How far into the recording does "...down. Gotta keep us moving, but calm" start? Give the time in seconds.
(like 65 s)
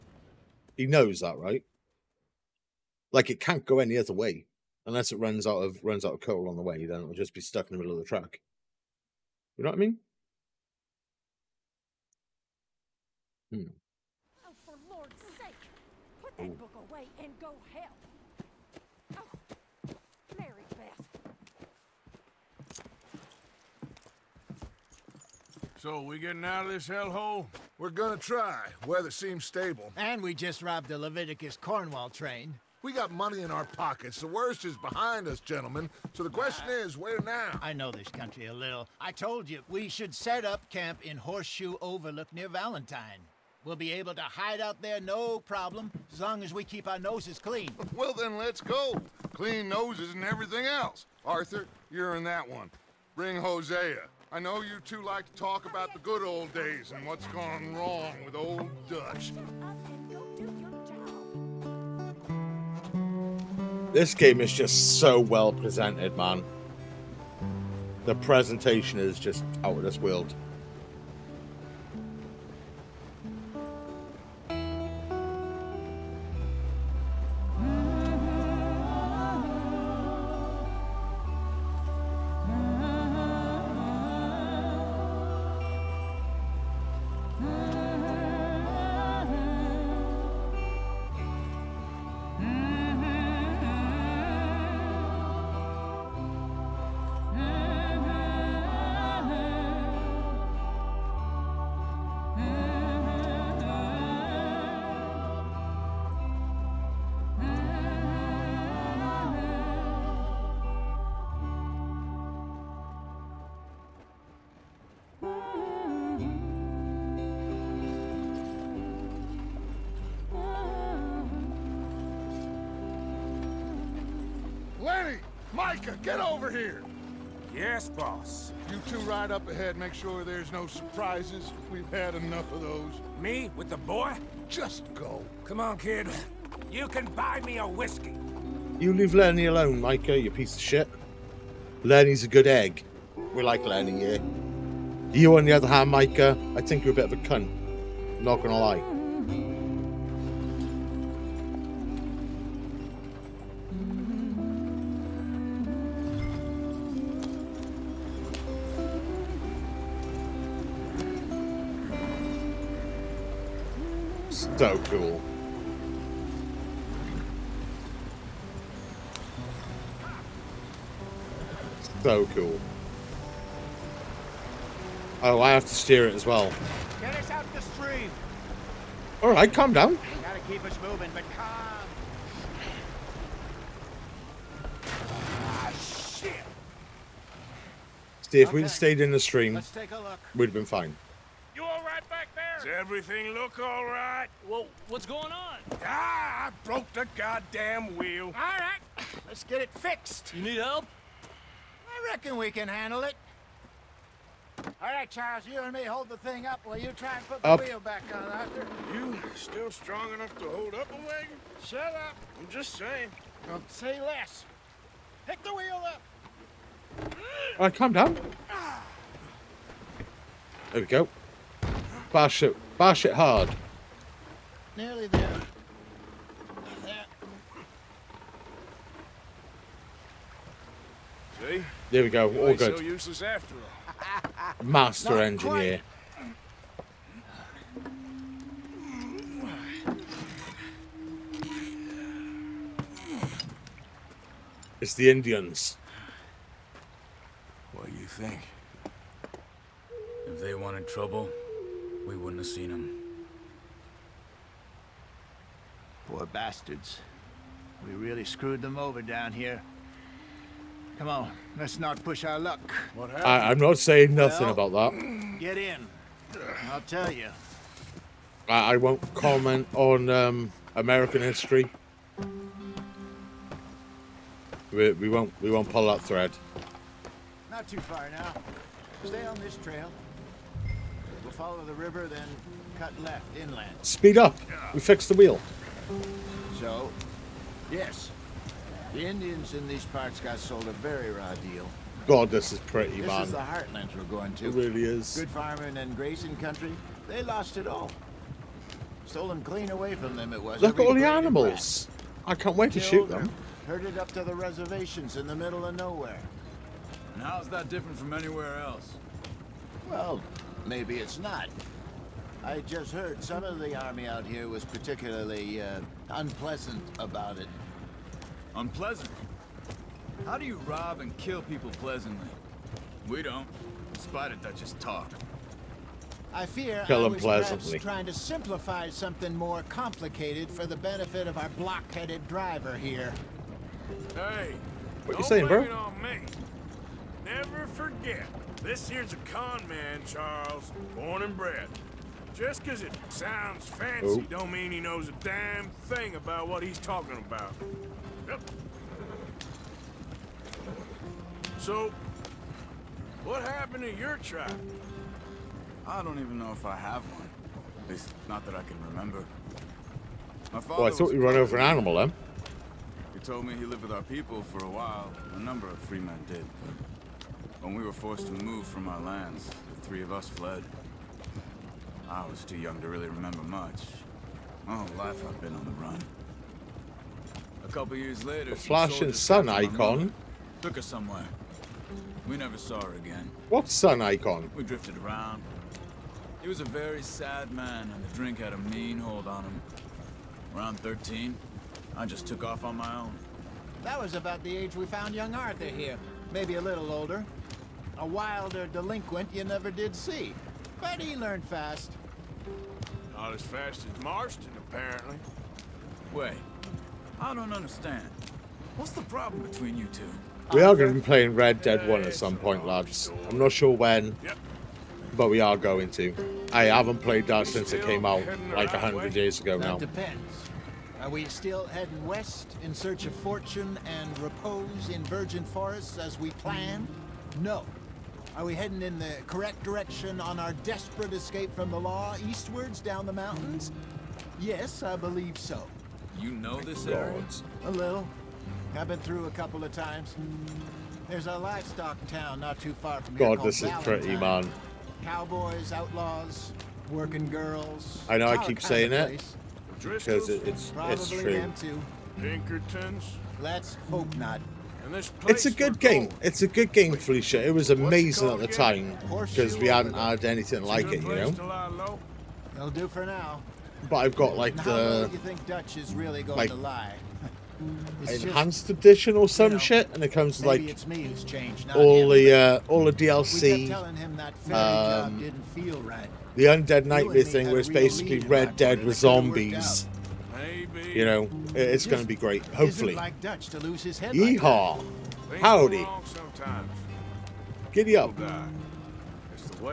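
179 s.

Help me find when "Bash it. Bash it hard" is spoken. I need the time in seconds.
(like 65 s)
222 s.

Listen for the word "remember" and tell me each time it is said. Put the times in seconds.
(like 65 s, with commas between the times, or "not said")
358 s, 373 s.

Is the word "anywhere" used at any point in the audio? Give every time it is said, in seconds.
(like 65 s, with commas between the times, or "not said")
308 s.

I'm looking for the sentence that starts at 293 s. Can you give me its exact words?
This is the heartlands we're going to.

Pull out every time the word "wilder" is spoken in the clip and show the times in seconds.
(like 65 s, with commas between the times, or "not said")
398 s.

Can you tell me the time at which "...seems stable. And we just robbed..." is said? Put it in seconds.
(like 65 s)
29 s.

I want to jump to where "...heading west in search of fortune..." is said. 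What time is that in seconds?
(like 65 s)
421 s.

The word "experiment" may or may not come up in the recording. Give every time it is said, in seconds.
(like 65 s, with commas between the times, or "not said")
not said.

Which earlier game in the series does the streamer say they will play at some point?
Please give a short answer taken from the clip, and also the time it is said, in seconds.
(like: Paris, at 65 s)
Red Dead 1, at 411 s.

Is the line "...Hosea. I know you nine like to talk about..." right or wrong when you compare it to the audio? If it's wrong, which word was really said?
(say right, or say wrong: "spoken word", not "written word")
wrong: "two", not "nine".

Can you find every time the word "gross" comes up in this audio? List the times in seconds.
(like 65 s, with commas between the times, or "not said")
not said.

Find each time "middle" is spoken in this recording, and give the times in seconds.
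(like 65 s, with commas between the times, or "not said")
7 s, 305 s.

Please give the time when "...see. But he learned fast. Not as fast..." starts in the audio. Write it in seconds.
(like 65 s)
399 s.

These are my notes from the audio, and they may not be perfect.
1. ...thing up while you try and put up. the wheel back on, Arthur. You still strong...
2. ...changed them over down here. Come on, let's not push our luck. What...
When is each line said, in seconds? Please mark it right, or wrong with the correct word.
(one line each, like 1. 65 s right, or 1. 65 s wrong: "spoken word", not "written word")
1. 206 s right
2. 258 s wrong: "screwed", not "changed".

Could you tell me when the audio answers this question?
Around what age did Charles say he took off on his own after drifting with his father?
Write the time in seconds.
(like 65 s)
390 s.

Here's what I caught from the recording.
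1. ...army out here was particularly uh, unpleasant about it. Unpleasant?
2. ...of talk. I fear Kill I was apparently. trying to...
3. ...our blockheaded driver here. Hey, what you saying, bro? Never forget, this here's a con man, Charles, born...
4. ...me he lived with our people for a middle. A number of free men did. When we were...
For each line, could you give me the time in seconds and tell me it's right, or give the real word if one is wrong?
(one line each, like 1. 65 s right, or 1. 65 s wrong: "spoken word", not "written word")
1. 313 s right
2. 324 s wrong: "pleasantly", not "apparently"
3. 331 s right
4. 363 s wrong: "while", not "middle".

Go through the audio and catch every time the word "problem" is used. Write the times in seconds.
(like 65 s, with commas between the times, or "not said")
45 s, 409 s.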